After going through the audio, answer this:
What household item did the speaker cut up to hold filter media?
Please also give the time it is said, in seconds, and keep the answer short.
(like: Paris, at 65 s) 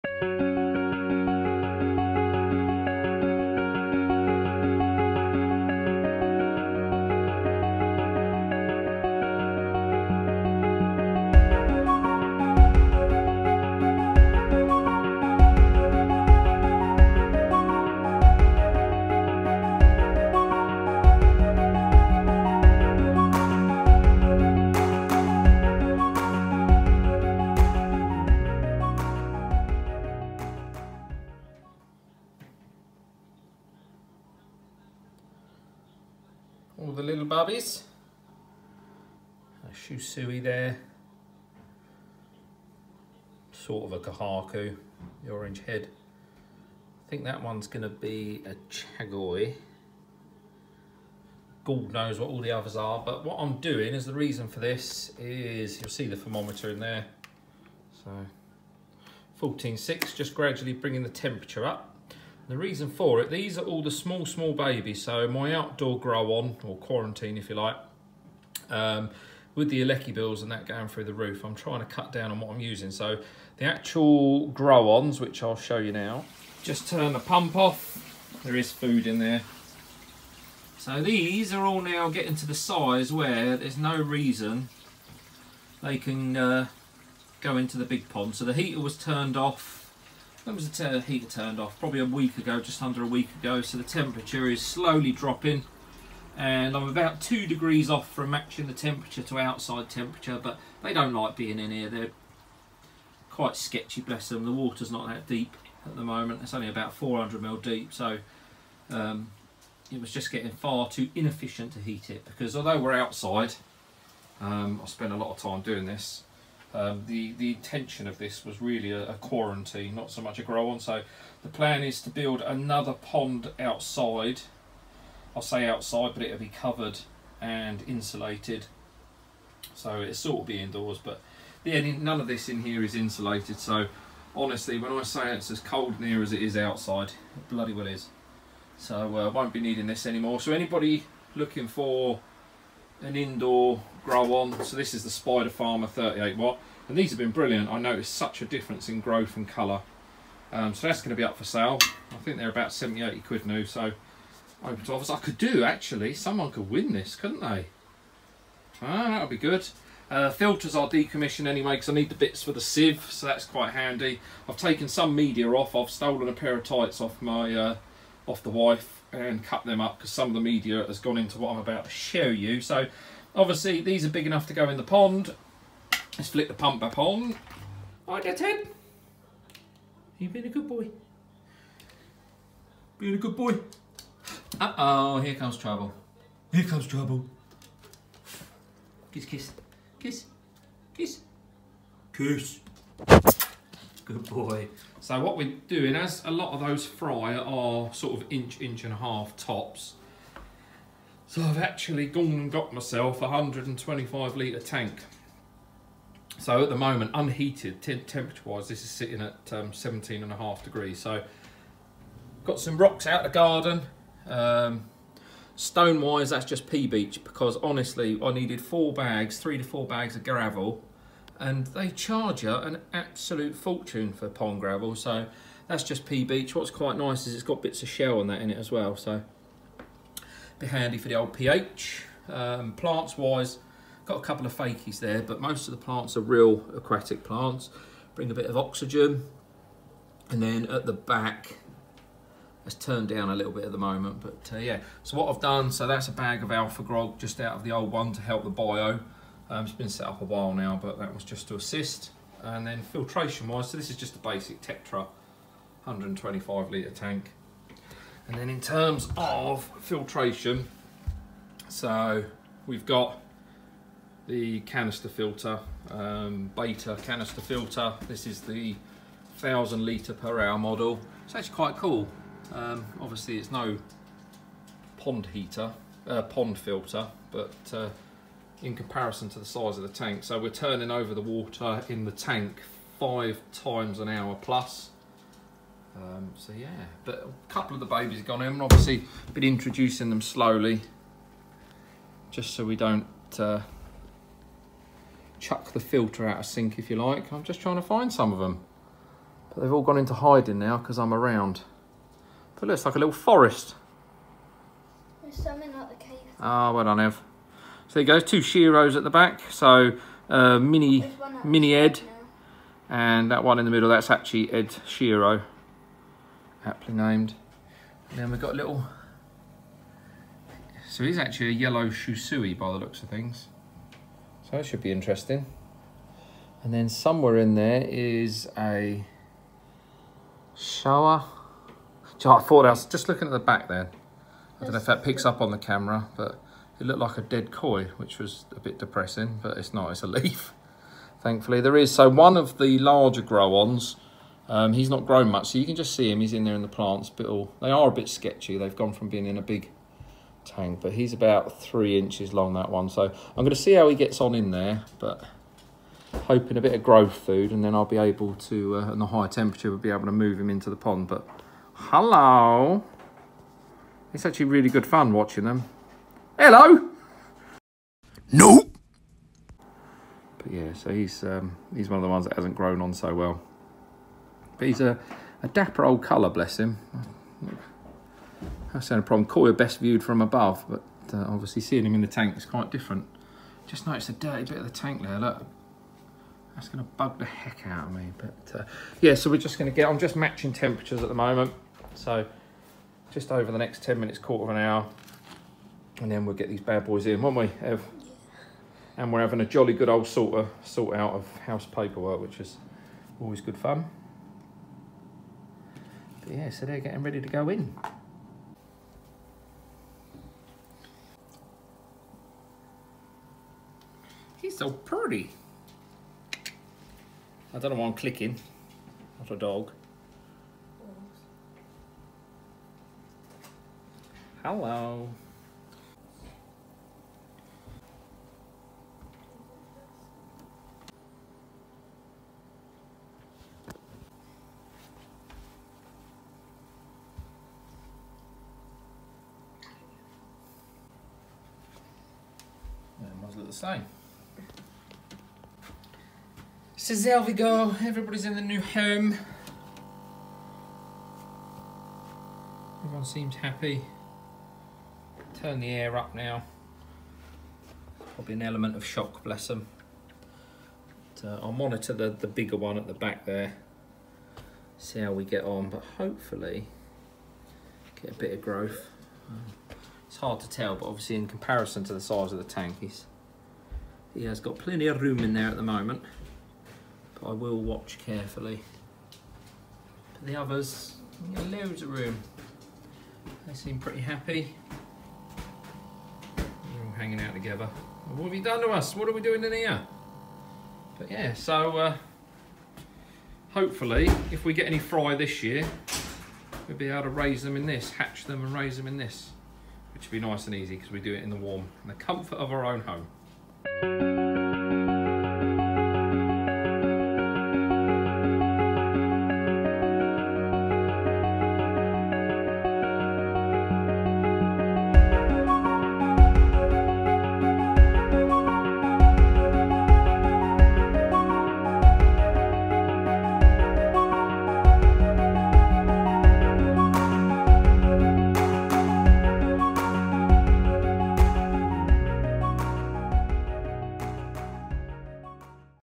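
tights, at 166 s.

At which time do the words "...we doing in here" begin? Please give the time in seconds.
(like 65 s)
489 s.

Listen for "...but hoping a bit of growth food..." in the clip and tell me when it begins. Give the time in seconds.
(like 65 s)
354 s.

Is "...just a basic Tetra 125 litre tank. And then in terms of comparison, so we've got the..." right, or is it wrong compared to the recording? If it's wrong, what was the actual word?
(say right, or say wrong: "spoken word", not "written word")
wrong: "filtration", not "comparison".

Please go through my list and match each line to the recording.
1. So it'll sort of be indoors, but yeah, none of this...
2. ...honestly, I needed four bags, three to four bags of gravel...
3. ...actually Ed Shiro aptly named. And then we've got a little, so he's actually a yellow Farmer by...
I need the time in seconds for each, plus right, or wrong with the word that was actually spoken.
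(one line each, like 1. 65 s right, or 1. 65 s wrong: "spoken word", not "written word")
1. 129 s right
2. 217 s right
3. 314 s wrong: "Shusui", not "Farmer".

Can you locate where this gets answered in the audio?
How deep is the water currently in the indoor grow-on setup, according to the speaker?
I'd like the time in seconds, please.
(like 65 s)
106 s.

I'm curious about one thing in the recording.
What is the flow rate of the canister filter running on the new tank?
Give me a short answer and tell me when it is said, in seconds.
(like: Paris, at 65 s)
1000 litres per hour, at 269 s.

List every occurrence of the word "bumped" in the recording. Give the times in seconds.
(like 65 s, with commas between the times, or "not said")
not said.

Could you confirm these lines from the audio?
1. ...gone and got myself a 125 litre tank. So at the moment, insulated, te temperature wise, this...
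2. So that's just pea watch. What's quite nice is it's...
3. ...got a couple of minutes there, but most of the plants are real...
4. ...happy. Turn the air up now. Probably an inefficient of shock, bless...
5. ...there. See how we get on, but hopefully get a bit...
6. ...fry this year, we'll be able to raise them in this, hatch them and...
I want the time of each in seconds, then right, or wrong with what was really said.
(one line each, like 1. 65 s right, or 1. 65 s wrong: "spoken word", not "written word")
1. 202 s wrong: "unheated", not "insulated"
2. 224 s wrong: "beach", not "watch"
3. 234 s wrong: "fakies", not "minutes"
4. 453 s wrong: "element", not "inefficient"
5. 463 s right
6. 494 s right.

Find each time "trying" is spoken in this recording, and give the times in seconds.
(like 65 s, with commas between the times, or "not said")
71 s, 297 s.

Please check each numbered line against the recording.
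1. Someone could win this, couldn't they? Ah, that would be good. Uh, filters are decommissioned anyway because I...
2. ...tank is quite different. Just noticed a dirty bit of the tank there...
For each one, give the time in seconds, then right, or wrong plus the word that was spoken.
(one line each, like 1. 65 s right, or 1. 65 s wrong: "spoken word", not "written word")
1. 156 s right
2. 382 s right.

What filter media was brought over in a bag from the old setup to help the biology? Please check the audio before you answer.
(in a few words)
Alfagrog.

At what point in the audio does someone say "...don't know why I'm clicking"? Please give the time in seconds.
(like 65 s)
417 s.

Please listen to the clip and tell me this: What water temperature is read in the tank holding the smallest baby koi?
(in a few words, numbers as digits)
14.6.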